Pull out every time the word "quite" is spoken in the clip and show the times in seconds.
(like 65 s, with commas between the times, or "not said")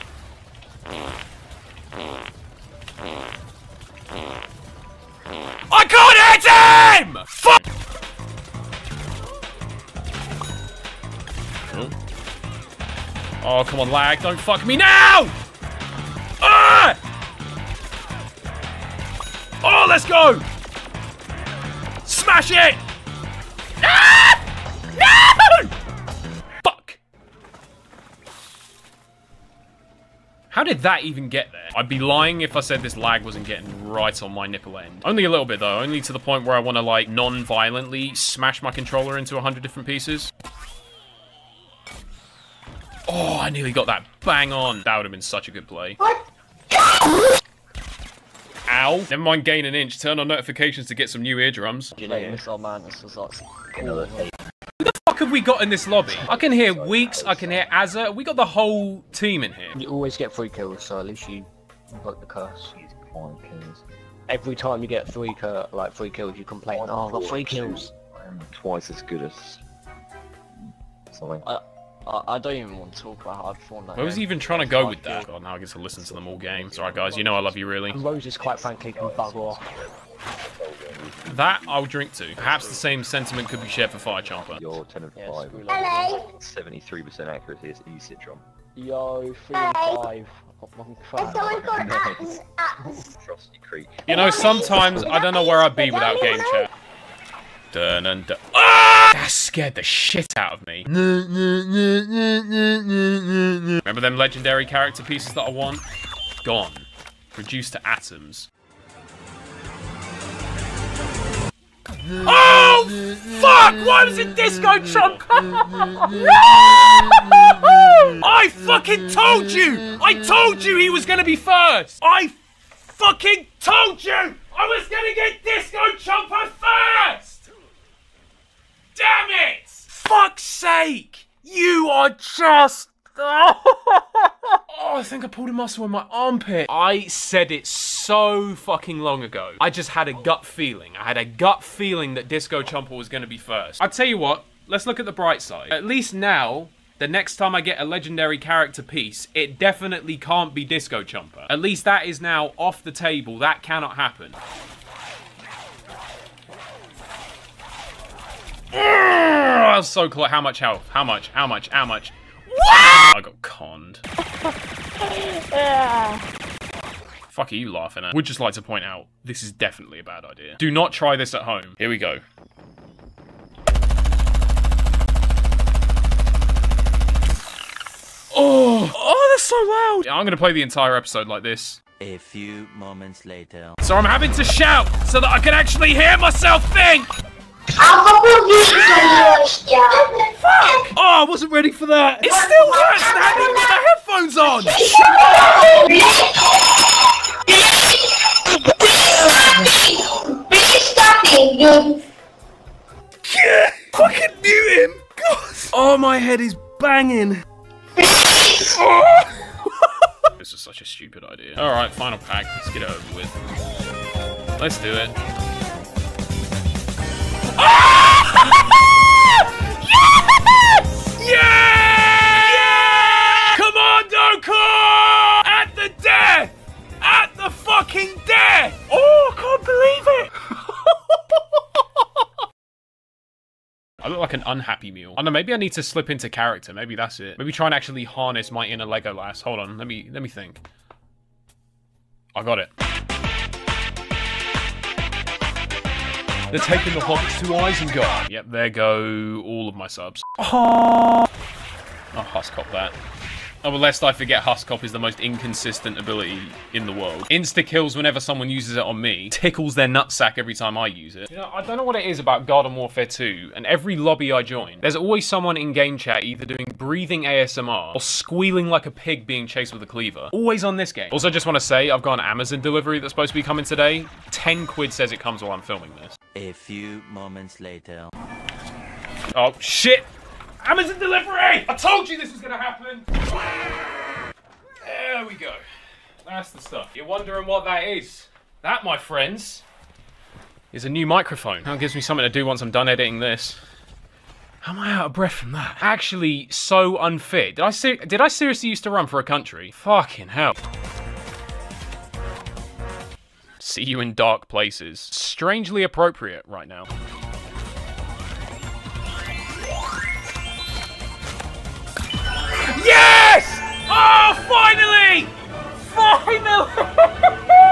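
78 s.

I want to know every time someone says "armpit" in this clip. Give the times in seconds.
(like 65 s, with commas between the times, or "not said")
136 s.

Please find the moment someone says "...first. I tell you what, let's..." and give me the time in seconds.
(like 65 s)
143 s.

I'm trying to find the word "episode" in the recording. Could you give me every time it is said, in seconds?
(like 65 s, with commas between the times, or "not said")
180 s.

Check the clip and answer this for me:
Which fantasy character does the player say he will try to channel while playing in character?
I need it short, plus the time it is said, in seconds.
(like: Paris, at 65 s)
Legolas, at 238 s.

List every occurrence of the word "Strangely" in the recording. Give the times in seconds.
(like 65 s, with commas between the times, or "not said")
304 s.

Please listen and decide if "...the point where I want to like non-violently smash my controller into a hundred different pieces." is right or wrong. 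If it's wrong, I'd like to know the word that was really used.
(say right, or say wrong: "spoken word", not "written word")
right.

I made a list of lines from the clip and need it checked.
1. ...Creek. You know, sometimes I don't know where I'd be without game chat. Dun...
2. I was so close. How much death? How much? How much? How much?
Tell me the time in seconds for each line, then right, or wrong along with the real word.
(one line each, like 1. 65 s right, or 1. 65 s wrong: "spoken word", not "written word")
1. 93 s right
2. 158 s wrong: "health", not "death".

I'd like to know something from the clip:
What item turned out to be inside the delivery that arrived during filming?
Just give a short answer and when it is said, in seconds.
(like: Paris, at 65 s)
a new microphone, at 290 s.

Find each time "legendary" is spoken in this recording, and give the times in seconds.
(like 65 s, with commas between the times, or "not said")
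104 s, 147 s.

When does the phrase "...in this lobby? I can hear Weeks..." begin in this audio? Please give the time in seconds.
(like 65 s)
55 s.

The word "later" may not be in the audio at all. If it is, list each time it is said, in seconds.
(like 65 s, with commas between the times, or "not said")
183 s, 277 s.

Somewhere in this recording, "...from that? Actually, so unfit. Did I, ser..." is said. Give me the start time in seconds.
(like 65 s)
295 s.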